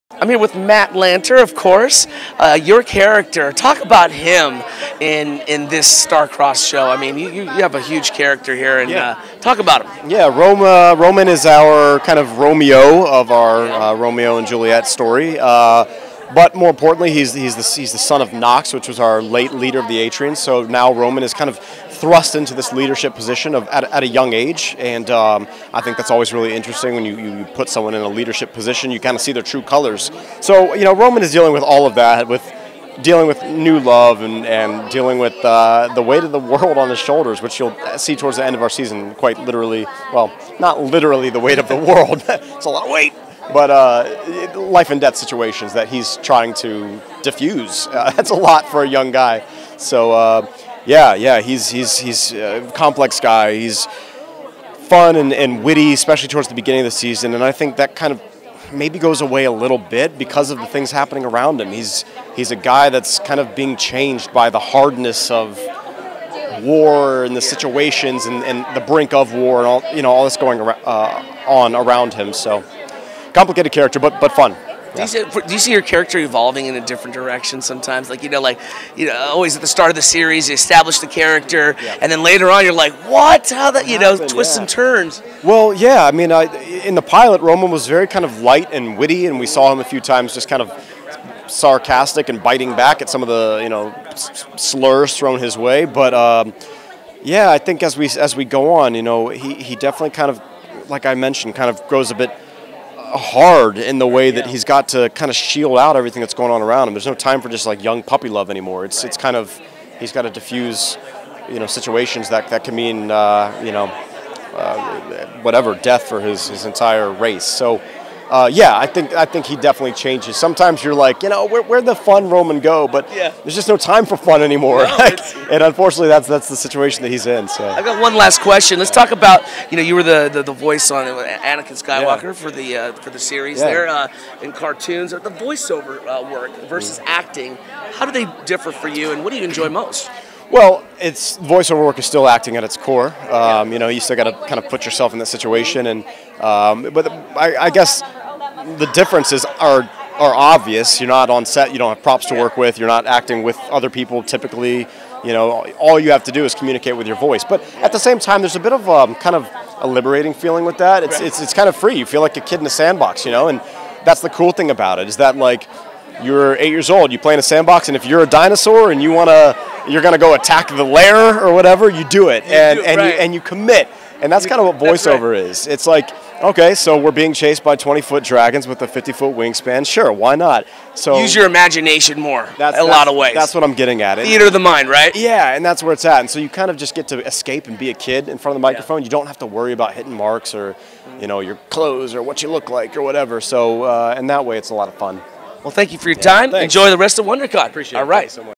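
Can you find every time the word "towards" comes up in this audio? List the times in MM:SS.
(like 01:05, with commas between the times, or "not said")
00:38, 00:56.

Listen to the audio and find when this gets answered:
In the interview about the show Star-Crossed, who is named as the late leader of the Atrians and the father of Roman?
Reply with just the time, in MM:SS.
00:18.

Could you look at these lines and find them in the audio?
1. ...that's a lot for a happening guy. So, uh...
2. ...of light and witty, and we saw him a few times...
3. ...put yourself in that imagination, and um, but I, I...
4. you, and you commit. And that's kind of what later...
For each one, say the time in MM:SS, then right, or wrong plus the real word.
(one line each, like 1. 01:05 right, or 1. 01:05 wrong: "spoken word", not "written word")
1. 00:48 wrong: "young", not "happening"
2. 01:28 right
3. 02:24 wrong: "situation", not "imagination"
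4. 02:53 wrong: "voiceover", not "later".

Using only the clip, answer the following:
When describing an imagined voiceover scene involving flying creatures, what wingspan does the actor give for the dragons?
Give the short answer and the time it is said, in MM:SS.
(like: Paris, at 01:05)
50 foot, at 02:58.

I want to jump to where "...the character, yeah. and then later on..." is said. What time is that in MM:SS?
01:20.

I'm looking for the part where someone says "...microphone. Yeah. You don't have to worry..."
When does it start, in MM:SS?
03:08.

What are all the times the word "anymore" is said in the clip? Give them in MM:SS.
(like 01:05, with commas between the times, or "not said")
01:48, 02:04.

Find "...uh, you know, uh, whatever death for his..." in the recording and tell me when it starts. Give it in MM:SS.
01:53.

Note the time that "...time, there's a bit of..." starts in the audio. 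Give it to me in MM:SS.
02:38.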